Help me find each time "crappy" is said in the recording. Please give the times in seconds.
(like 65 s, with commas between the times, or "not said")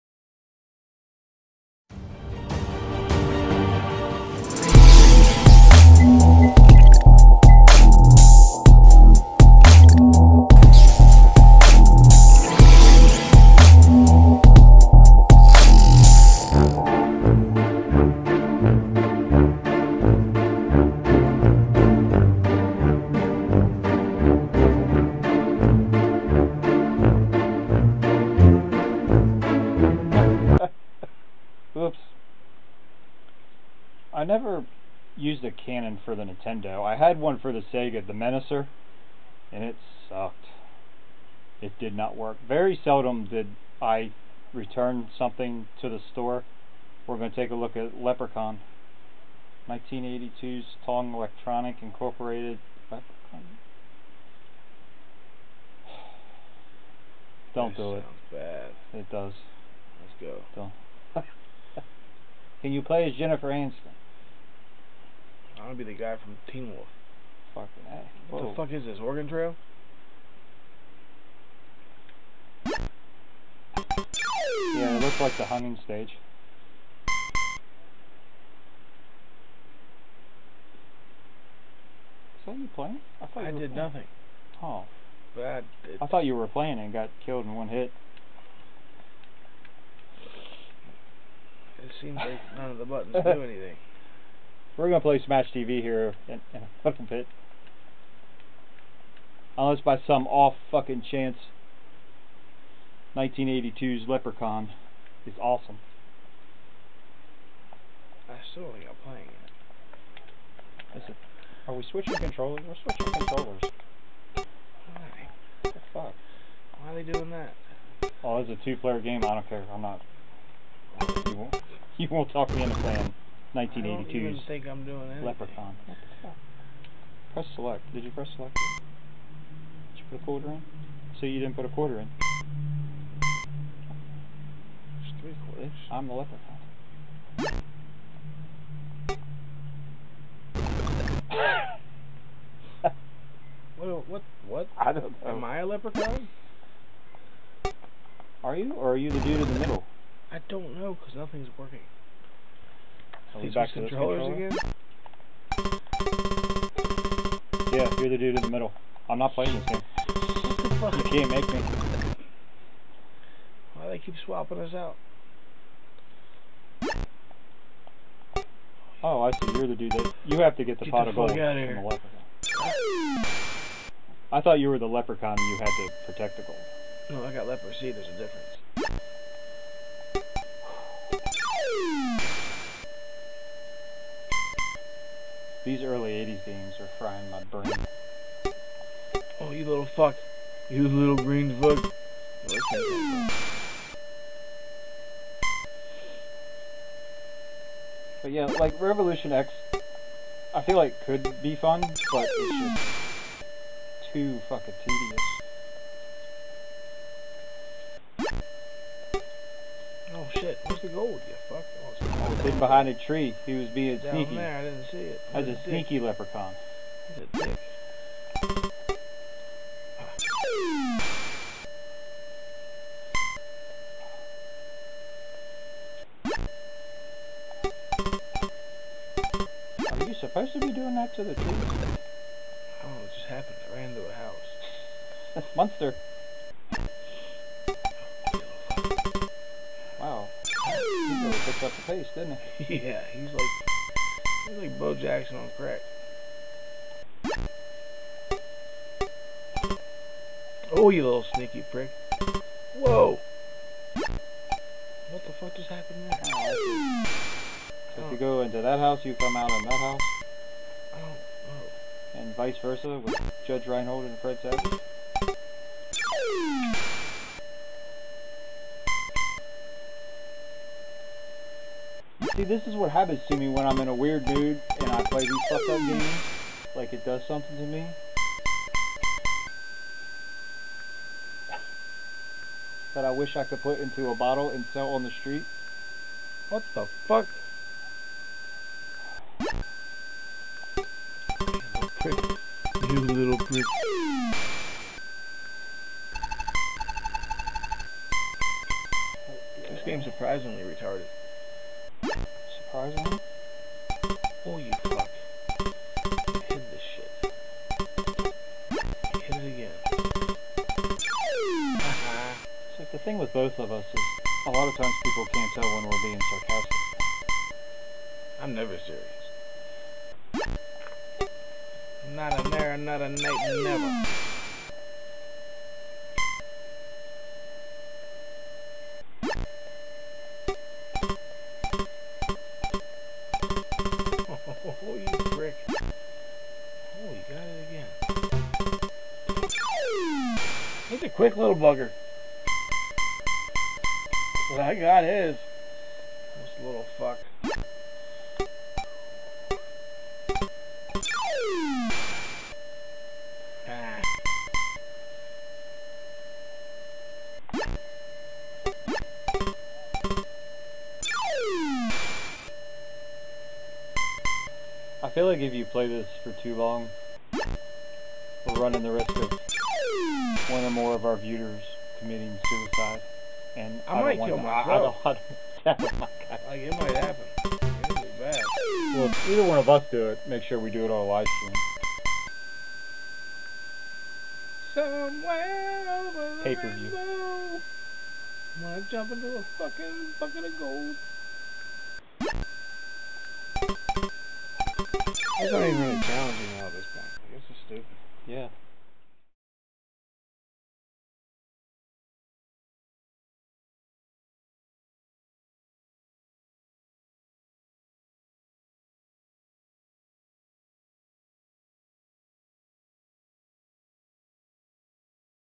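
not said.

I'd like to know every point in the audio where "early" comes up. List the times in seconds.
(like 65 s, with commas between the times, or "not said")
185 s.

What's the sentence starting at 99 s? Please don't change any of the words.
Unless by some off fucking chance 1982's Leprechaun is awesome.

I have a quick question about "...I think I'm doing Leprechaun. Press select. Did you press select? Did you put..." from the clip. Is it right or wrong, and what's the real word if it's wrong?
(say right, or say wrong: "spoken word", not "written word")
right.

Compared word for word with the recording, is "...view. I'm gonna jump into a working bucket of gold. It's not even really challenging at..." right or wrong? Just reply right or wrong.
wrong.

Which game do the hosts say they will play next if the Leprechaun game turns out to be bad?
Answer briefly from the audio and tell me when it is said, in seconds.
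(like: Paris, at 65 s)
Smash TV, at 95 s.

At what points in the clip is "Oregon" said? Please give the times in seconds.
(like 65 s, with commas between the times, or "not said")
68 s.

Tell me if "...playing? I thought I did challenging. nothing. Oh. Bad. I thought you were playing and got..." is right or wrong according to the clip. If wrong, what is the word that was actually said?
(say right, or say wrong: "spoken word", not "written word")
wrong: "playing", not "challenging".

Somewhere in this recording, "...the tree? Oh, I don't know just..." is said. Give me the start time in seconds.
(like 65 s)
231 s.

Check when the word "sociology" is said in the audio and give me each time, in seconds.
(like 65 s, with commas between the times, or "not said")
not said.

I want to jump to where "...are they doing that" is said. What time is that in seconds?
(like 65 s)
116 s.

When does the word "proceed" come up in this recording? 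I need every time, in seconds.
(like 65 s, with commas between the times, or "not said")
not said.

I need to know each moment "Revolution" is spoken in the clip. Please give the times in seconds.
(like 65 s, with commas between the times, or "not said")
198 s.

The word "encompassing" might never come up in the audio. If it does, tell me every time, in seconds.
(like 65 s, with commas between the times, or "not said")
not said.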